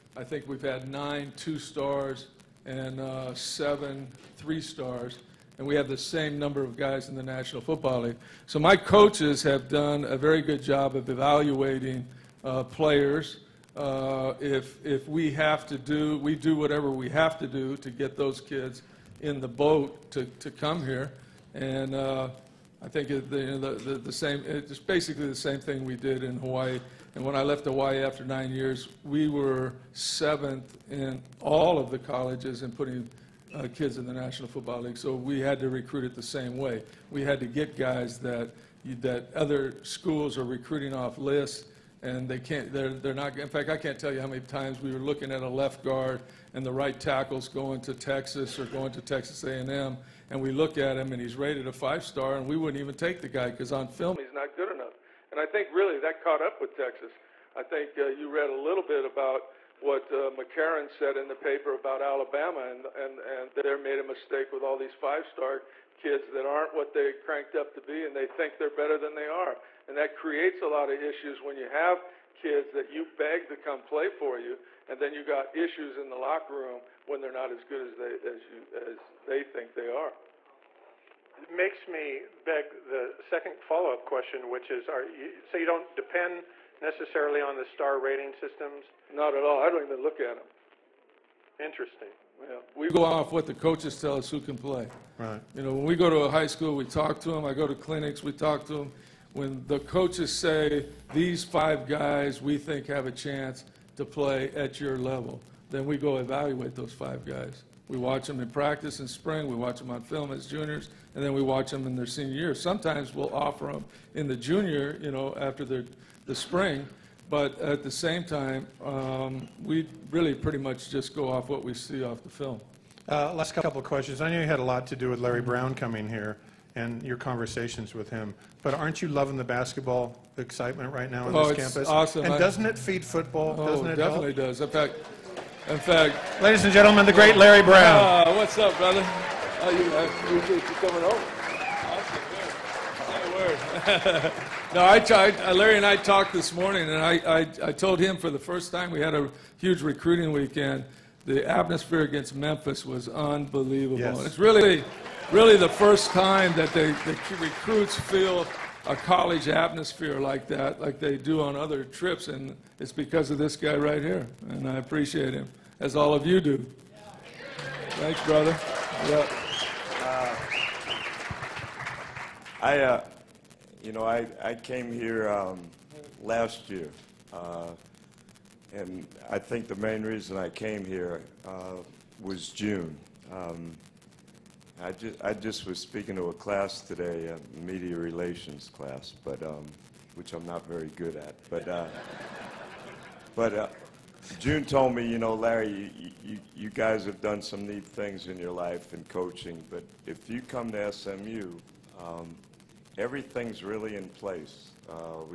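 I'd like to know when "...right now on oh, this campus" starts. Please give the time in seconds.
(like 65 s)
130 s.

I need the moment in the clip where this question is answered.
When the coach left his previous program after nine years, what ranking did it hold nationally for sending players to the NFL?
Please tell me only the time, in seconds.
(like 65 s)
29 s.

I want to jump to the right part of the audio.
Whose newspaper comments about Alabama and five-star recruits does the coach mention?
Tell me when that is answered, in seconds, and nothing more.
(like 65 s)
60 s.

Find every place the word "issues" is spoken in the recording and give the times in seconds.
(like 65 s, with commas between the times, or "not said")
71 s, 75 s.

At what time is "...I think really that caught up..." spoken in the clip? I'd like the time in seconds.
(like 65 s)
55 s.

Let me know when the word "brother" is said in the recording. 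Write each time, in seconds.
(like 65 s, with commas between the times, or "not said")
138 s, 168 s.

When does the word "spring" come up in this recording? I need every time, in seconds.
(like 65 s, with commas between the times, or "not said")
109 s, 116 s.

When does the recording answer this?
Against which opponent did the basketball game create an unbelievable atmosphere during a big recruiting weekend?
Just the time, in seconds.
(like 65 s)
152 s.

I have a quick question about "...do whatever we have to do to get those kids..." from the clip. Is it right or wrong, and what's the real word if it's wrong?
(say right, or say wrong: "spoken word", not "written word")
right.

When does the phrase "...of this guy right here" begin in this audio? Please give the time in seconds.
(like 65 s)
163 s.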